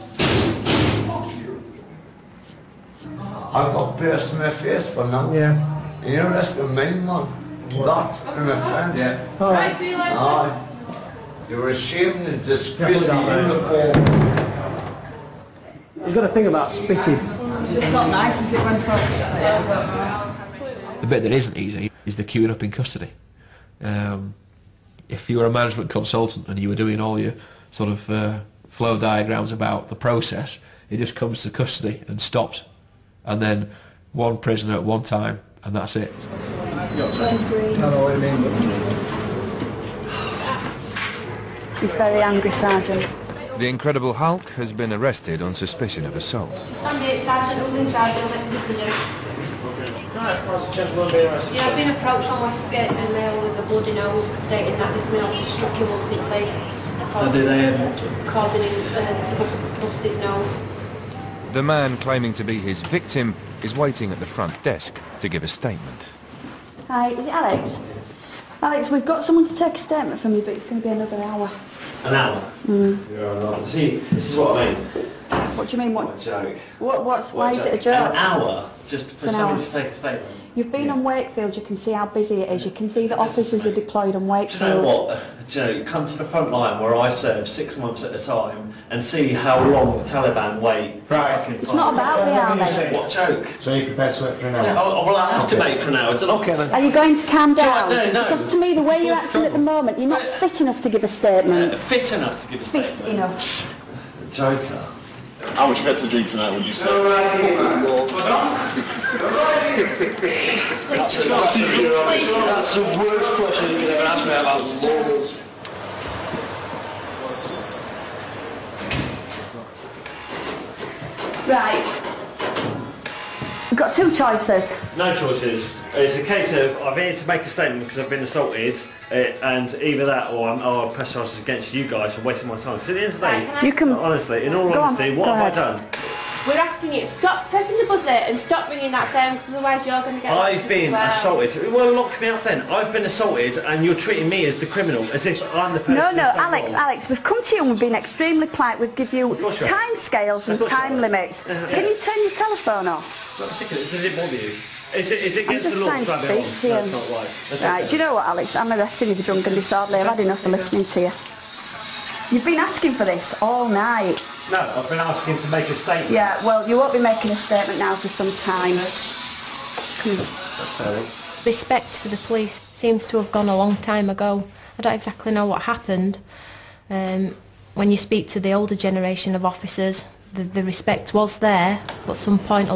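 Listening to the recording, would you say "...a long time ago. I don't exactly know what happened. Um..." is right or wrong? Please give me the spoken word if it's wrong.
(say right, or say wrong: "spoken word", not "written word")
right.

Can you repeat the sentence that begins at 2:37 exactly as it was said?
right, do you know what, Alex?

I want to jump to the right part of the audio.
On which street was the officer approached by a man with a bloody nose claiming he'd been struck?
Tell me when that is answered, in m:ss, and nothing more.
0:52.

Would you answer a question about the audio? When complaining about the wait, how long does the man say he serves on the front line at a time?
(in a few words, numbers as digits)
6 months.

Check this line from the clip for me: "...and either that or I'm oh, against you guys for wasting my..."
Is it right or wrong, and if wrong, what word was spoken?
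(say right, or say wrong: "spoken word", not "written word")
right.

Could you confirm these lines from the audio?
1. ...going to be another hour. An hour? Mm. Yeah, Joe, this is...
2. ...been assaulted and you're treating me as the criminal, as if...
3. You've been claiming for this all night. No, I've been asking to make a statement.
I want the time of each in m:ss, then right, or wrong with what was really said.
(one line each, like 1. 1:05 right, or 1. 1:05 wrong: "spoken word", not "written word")
1. 1:10 wrong: "See", not "Joe"
2. 2:22 right
3. 2:42 wrong: "asking", not "claiming".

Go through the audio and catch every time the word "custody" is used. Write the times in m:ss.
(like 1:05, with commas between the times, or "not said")
0:22, 0:31.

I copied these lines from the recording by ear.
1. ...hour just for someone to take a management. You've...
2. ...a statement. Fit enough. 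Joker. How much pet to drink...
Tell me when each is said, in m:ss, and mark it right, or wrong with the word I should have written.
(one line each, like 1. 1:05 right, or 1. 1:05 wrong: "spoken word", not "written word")
1. 1:18 wrong: "statement", not "management"
2. 1:42 right.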